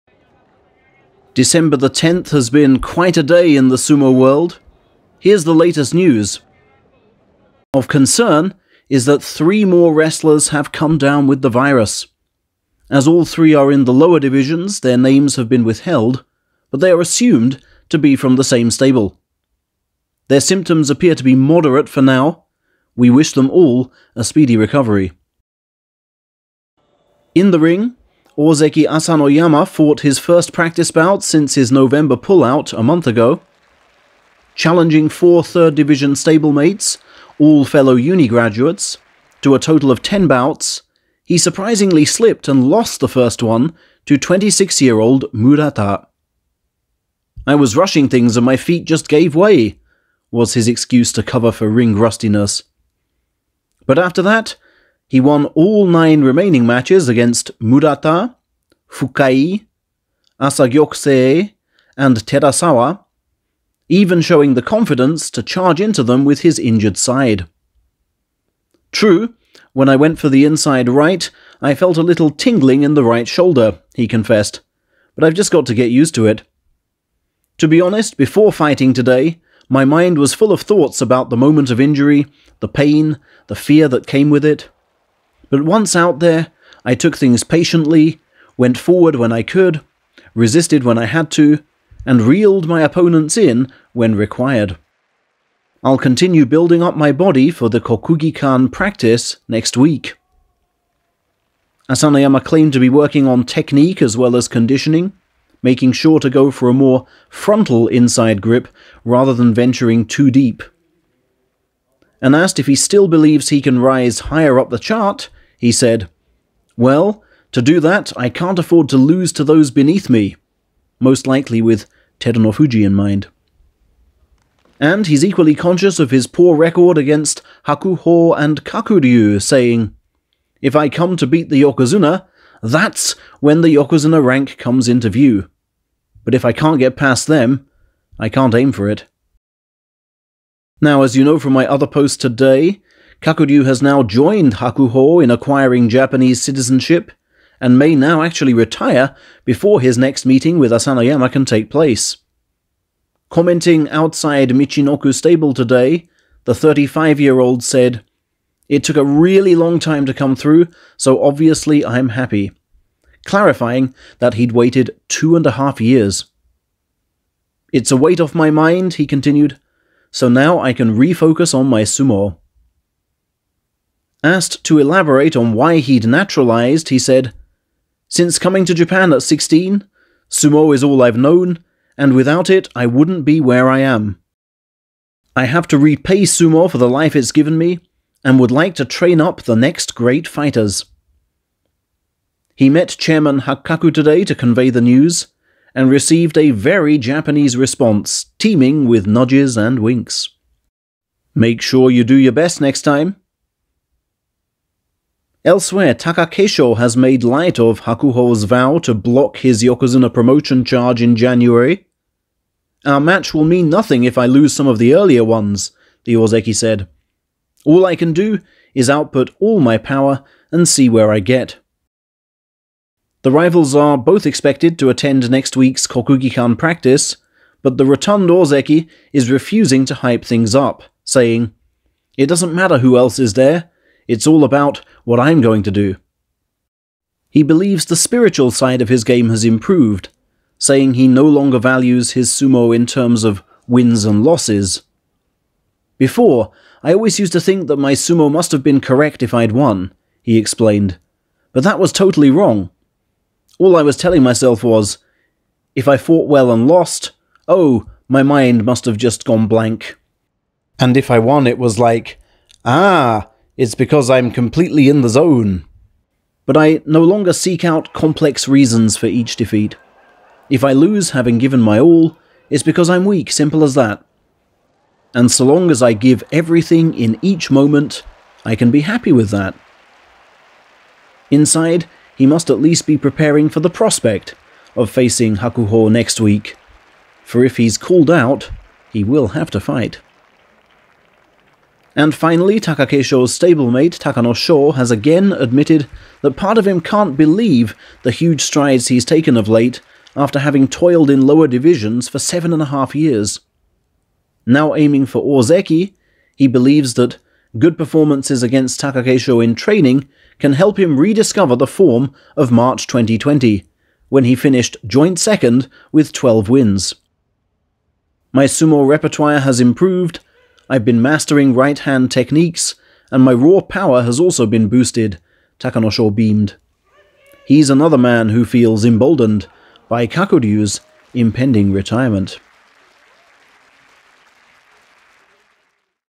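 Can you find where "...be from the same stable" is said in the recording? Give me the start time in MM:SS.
00:17.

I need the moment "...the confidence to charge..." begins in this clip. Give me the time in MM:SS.
01:04.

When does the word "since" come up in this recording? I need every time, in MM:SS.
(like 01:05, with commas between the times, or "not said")
00:31, 02:58.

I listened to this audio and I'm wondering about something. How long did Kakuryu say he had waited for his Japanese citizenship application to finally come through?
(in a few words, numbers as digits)
2 and a half years.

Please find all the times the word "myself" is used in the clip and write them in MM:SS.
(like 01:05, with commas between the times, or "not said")
04:14.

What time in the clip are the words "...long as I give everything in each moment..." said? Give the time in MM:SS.
04:35.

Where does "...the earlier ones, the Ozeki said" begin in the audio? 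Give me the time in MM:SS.
03:34.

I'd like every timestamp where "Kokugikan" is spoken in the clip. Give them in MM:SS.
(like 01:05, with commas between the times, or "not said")
01:37, 03:45.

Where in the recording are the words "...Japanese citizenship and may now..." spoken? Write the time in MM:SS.
02:25.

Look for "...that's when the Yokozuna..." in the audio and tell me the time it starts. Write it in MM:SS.
02:12.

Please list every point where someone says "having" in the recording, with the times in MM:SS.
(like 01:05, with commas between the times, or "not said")
04:31, 05:00.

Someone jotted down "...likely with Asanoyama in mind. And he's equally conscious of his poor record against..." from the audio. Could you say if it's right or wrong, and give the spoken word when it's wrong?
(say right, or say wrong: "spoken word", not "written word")
wrong: "Terunofuji", not "Asanoyama".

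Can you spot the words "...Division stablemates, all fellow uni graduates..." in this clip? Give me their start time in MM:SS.
00:35.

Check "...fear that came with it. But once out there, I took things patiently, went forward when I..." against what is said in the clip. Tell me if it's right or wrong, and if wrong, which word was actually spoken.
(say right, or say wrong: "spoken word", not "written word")
right.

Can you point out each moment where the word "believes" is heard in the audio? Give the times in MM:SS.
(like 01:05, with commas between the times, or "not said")
01:53, 03:57, 04:57, 05:06.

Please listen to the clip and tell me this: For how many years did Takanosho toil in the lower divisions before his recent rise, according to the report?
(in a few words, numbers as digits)
7 and a half years.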